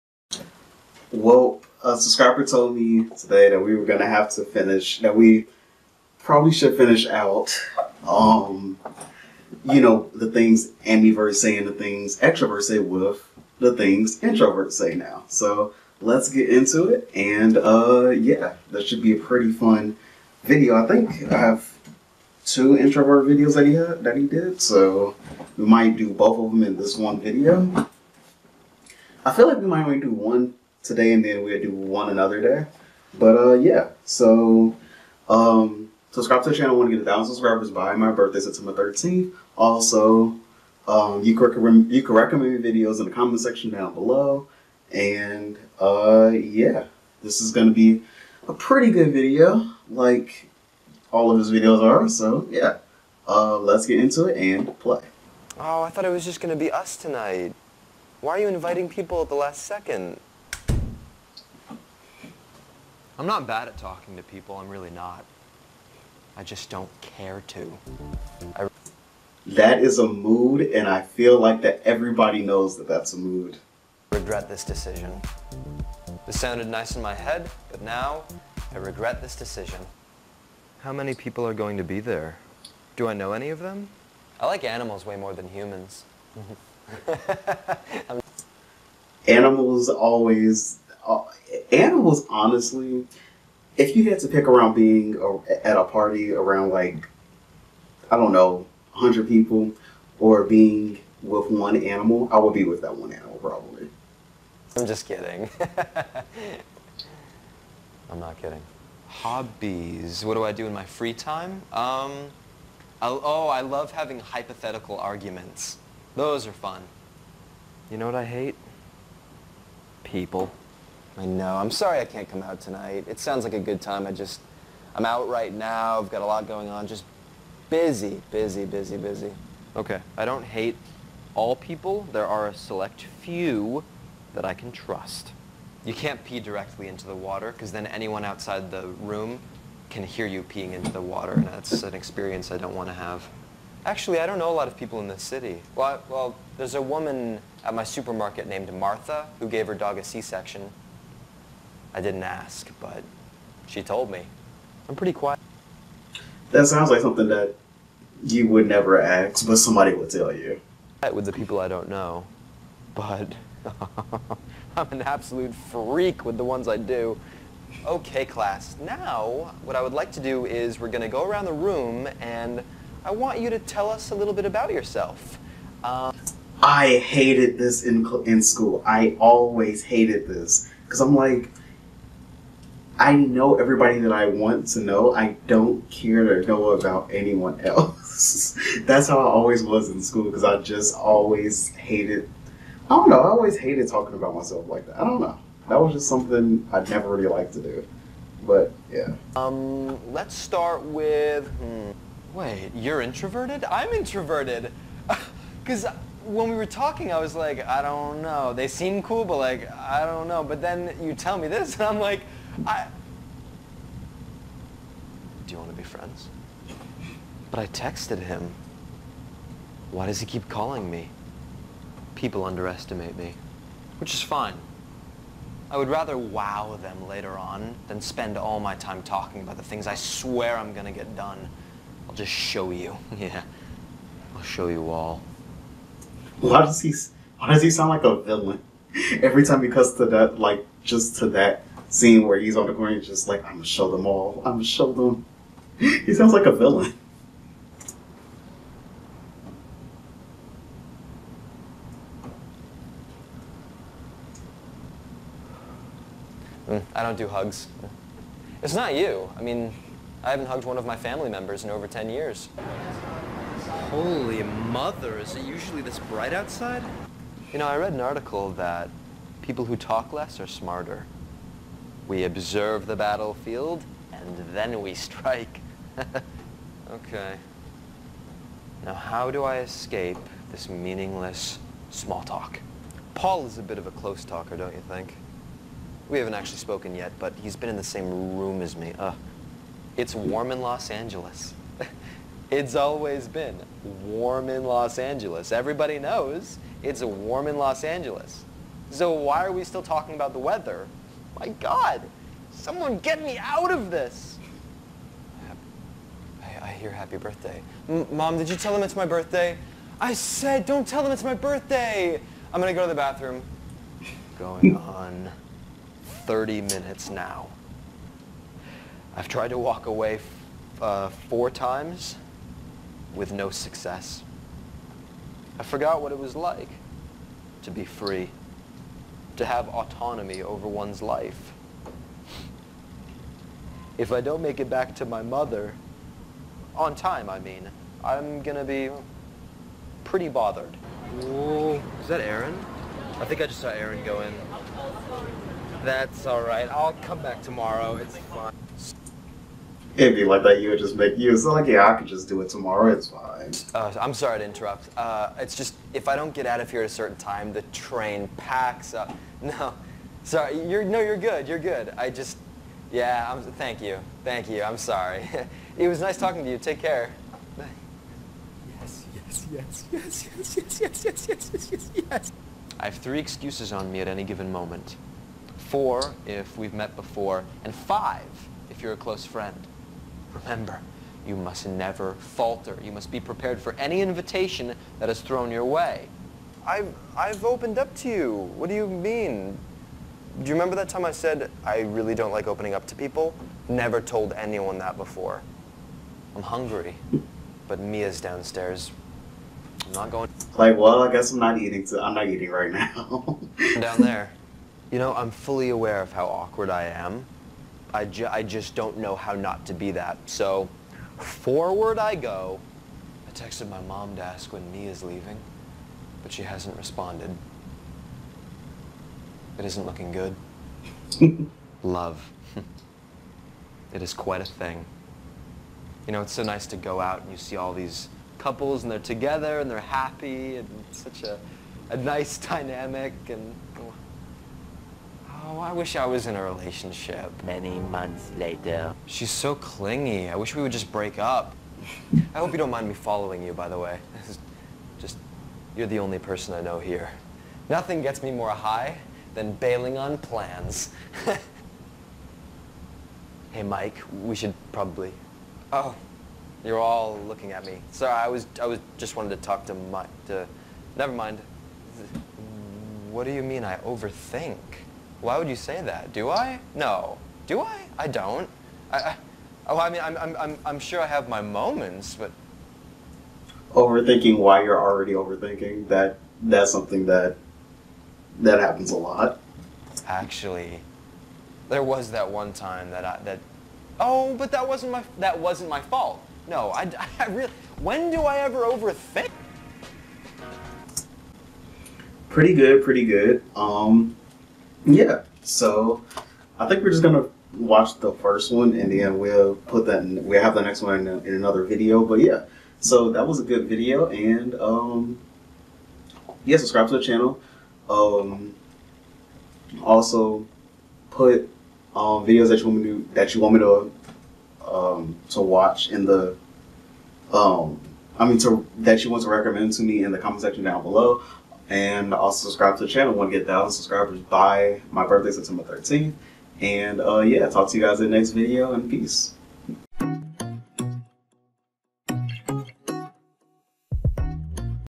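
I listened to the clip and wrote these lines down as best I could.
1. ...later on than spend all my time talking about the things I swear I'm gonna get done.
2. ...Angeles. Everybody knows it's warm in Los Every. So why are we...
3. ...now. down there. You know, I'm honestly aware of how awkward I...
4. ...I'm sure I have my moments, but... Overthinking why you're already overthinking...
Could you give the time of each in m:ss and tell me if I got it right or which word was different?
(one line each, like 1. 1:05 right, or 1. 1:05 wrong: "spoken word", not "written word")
1. 3:47 right
2. 4:54 wrong: "Angeles", not "Every"
3. 6:42 wrong: "fully", not "honestly"
4. 7:50 right.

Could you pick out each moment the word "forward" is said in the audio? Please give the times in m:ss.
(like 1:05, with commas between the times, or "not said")
6:51.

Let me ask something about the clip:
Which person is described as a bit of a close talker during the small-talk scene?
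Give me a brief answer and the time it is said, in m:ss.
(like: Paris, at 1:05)
Paul, at 4:43.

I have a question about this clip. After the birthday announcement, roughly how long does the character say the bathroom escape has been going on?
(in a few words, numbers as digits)
30 minutes.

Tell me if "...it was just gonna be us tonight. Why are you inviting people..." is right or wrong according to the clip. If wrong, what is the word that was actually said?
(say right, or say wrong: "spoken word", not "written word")
right.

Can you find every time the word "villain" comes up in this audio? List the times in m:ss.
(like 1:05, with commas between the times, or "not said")
3:58, 4:06.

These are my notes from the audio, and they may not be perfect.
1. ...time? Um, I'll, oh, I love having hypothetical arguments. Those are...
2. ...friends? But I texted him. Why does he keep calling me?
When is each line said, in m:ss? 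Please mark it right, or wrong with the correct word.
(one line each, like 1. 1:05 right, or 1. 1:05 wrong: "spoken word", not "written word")
1. 1:51 right
2. 3:35 right.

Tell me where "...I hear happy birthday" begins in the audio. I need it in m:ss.
5:06.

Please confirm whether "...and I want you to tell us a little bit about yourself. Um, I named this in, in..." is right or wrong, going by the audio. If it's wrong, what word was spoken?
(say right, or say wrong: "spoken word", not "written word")
wrong: "hated", not "named".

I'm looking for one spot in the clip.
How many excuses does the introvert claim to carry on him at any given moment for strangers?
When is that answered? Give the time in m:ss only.
6:12.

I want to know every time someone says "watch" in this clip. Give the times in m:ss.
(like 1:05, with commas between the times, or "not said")
8:17, 8:35.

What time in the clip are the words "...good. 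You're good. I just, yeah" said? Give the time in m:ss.
6:01.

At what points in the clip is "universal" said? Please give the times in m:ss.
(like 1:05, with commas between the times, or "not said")
not said.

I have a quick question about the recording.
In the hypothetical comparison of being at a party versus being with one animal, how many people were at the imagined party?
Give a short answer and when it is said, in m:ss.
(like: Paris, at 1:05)
100, at 1:38.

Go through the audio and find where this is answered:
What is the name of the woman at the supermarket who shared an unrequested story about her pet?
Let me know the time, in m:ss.
2:28.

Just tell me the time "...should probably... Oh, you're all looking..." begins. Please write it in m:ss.
7:34.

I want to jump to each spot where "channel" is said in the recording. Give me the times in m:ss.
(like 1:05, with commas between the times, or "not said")
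0:36, 8:27, 8:42.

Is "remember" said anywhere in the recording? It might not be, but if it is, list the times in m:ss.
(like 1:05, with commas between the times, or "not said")
6:20, 6:30.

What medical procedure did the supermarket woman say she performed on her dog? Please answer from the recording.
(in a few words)
C-section.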